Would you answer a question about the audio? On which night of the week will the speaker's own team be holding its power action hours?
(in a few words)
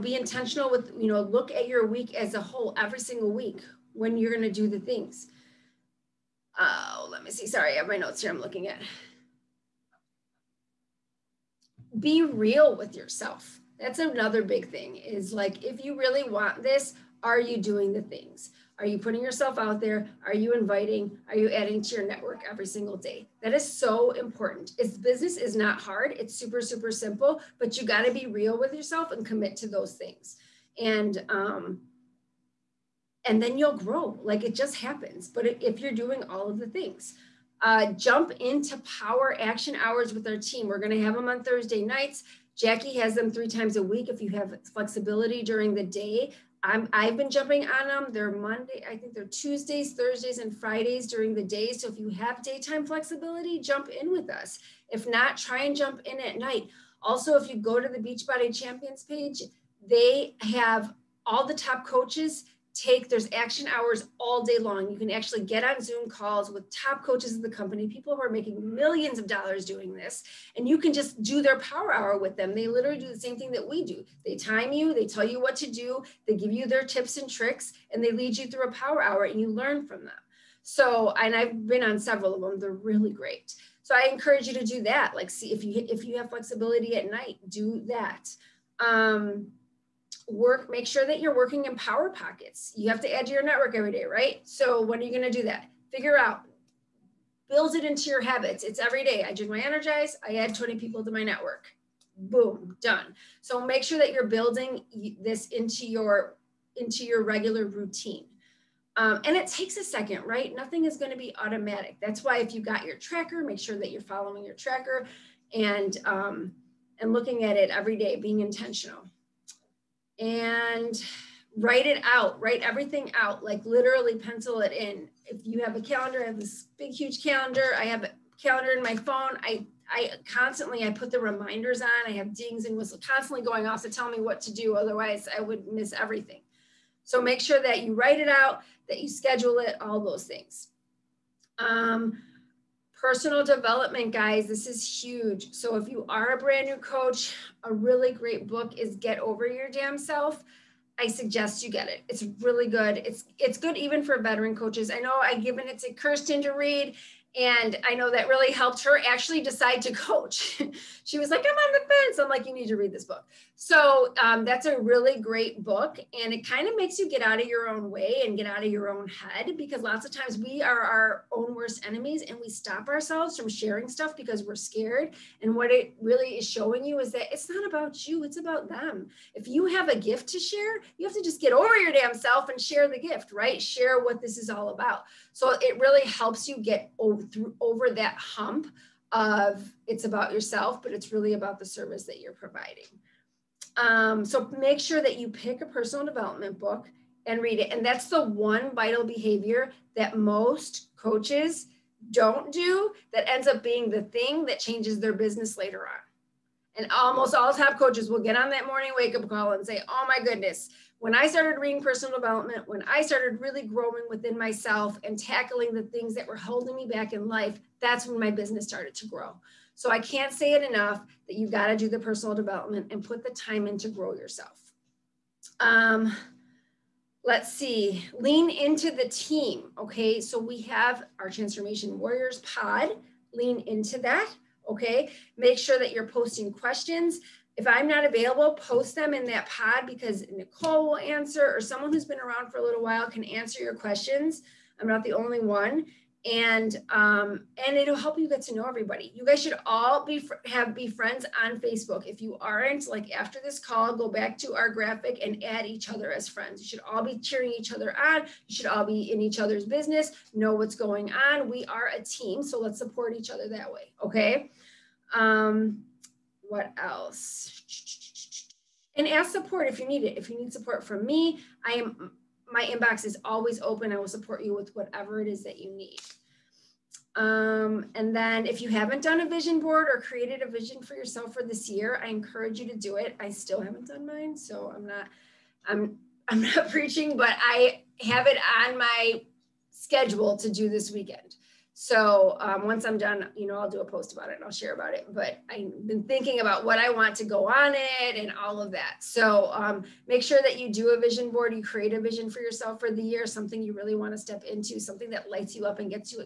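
Thursday.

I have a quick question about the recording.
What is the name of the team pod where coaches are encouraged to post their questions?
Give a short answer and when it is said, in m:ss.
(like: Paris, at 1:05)
Transformation Warriors, at 3:51.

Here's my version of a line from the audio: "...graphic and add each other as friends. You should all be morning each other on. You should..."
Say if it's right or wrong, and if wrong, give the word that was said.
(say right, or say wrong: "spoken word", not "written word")
wrong: "cheering", not "morning".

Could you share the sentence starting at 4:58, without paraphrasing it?
So um, make sure that you do a vision board.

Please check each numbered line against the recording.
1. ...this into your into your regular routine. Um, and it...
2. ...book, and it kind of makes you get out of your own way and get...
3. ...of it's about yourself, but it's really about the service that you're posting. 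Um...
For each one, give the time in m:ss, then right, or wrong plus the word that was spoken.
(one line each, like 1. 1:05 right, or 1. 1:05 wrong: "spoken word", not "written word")
1. 1:45 right
2. 2:45 right
3. 3:09 wrong: "providing", not "posting".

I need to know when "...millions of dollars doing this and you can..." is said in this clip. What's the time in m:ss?
1:08.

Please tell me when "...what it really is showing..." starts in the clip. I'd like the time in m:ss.
2:55.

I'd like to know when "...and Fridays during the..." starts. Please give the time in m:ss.
0:50.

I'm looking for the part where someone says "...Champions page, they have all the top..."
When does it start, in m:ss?
0:58.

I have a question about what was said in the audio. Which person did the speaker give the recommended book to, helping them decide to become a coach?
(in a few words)
Kirsten.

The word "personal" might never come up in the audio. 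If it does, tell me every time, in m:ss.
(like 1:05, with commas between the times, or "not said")
2:23, 3:15, 3:31, 3:41.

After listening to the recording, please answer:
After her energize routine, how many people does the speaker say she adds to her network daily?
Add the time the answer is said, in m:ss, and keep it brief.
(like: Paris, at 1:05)
20, at 1:40.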